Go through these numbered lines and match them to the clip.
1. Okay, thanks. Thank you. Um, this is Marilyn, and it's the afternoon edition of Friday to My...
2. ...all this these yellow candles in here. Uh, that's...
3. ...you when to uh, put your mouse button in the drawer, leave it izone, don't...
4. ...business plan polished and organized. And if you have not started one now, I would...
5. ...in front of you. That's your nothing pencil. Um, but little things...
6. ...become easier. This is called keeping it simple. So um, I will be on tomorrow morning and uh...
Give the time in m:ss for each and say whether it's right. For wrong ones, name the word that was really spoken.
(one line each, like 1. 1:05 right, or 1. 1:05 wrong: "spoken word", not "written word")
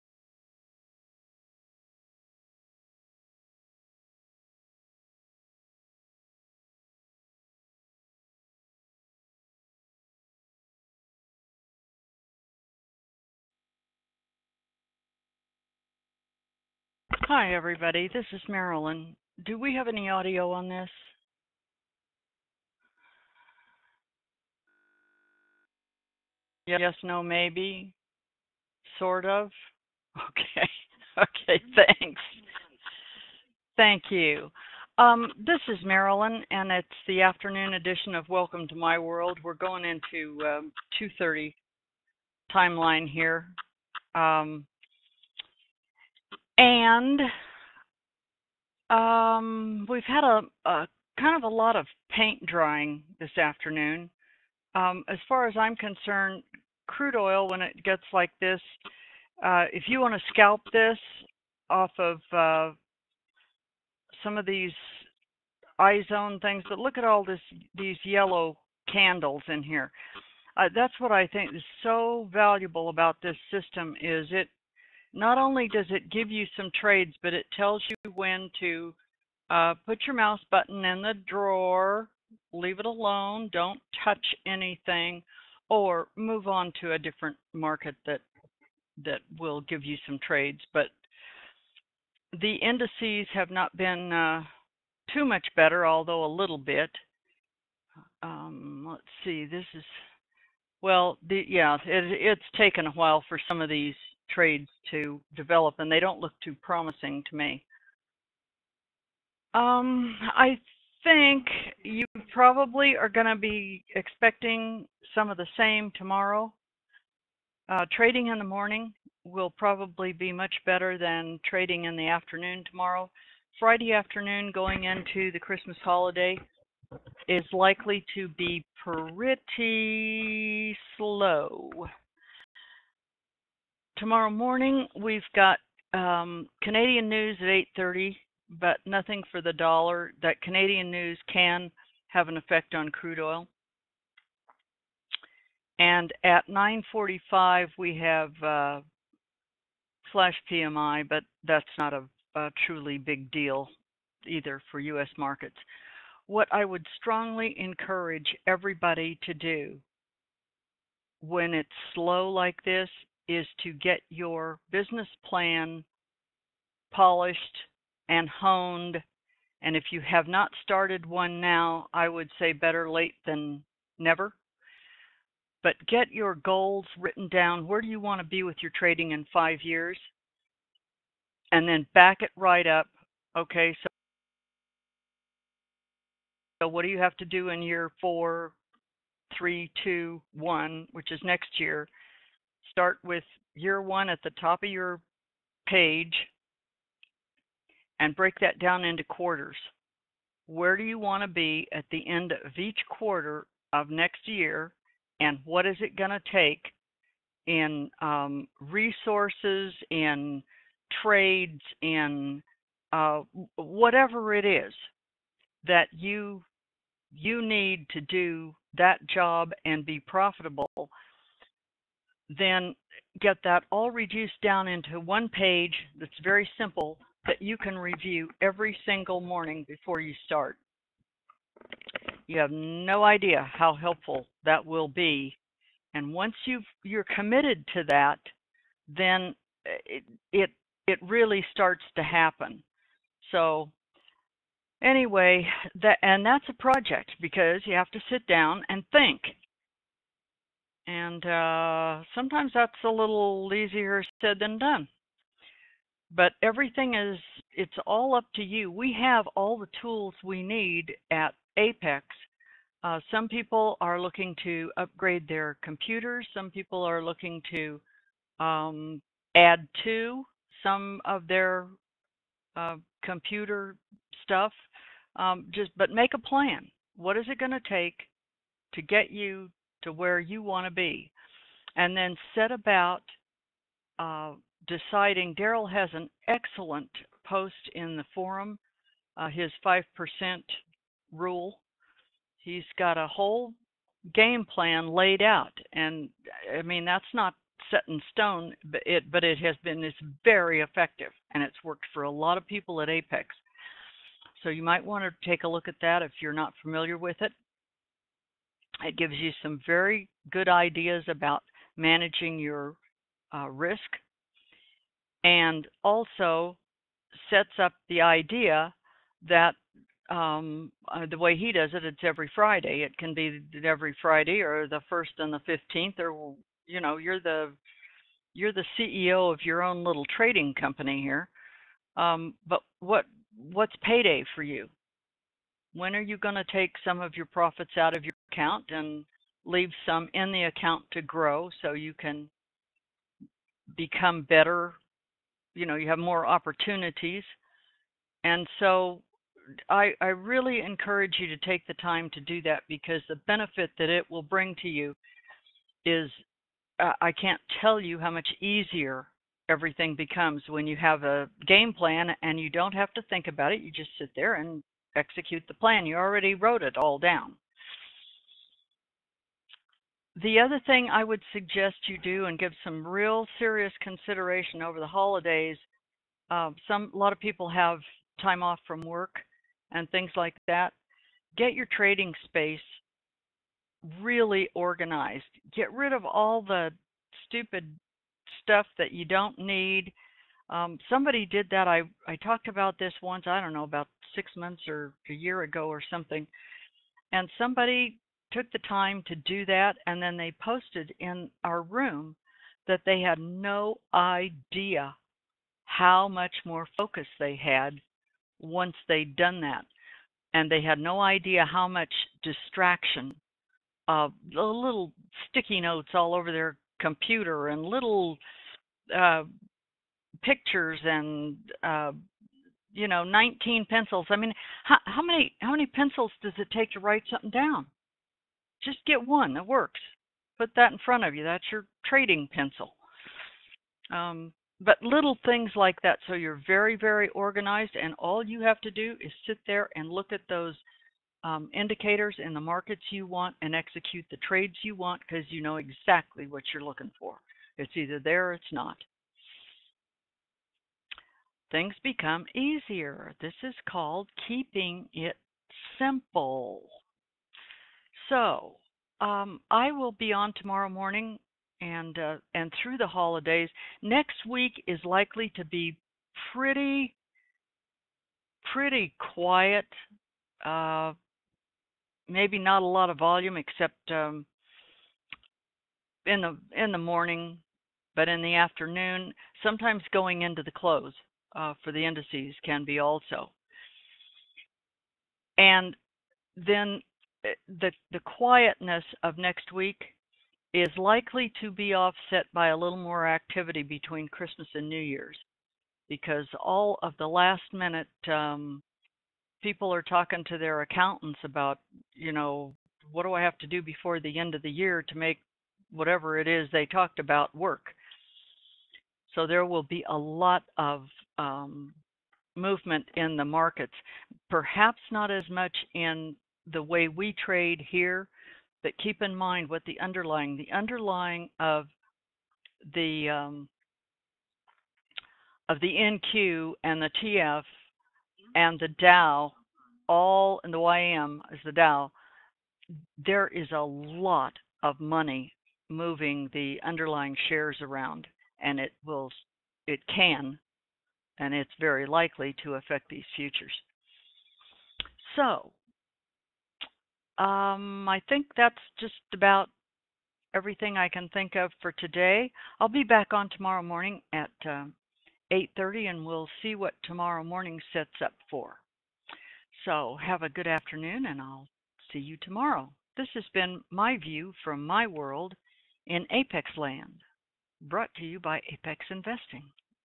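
1. 0:31 wrong: "Welcome", not "Friday"
2. 1:07 right
3. 1:17 wrong: "alone", not "izone"
4. 2:44 wrong: "honed", not "organized"
5. 7:10 wrong: "trading", not "nothing"
6. 7:31 right.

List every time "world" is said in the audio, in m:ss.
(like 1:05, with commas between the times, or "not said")
0:38, 9:24.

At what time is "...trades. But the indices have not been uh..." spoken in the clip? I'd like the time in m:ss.
1:30.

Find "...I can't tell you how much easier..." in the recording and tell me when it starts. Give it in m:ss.
5:57.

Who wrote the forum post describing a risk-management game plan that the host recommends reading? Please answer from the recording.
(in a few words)
Daryl.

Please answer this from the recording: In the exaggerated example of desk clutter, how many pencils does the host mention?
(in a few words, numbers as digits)
19.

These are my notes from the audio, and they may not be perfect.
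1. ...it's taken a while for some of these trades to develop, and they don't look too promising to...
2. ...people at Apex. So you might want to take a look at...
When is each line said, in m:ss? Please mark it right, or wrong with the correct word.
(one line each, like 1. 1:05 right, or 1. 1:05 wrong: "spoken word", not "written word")
1. 1:42 right
2. 5:02 right.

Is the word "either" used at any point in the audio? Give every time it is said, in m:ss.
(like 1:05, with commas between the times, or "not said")
2:34, 7:27.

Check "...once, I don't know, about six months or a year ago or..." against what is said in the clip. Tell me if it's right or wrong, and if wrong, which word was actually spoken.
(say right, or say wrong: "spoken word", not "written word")
right.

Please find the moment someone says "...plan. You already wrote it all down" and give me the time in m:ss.
6:05.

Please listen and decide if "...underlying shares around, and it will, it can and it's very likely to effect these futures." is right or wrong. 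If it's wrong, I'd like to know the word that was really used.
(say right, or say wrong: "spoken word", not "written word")
wrong: "affect", not "effect".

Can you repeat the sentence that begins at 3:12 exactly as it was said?
start with year one at the top of your page and break that down into quarters.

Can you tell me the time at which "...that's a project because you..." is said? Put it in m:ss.
4:06.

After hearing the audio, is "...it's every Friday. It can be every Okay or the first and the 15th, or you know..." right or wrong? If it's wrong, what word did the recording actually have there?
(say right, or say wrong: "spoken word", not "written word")
wrong: "Friday", not "Okay".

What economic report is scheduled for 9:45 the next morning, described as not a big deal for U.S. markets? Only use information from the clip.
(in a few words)
Flash PMI.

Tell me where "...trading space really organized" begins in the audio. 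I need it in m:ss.
6:21.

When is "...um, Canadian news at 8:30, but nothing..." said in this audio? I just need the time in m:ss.
2:15.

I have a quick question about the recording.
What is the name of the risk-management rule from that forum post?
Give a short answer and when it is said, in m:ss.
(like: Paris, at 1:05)
5% rule, at 4:49.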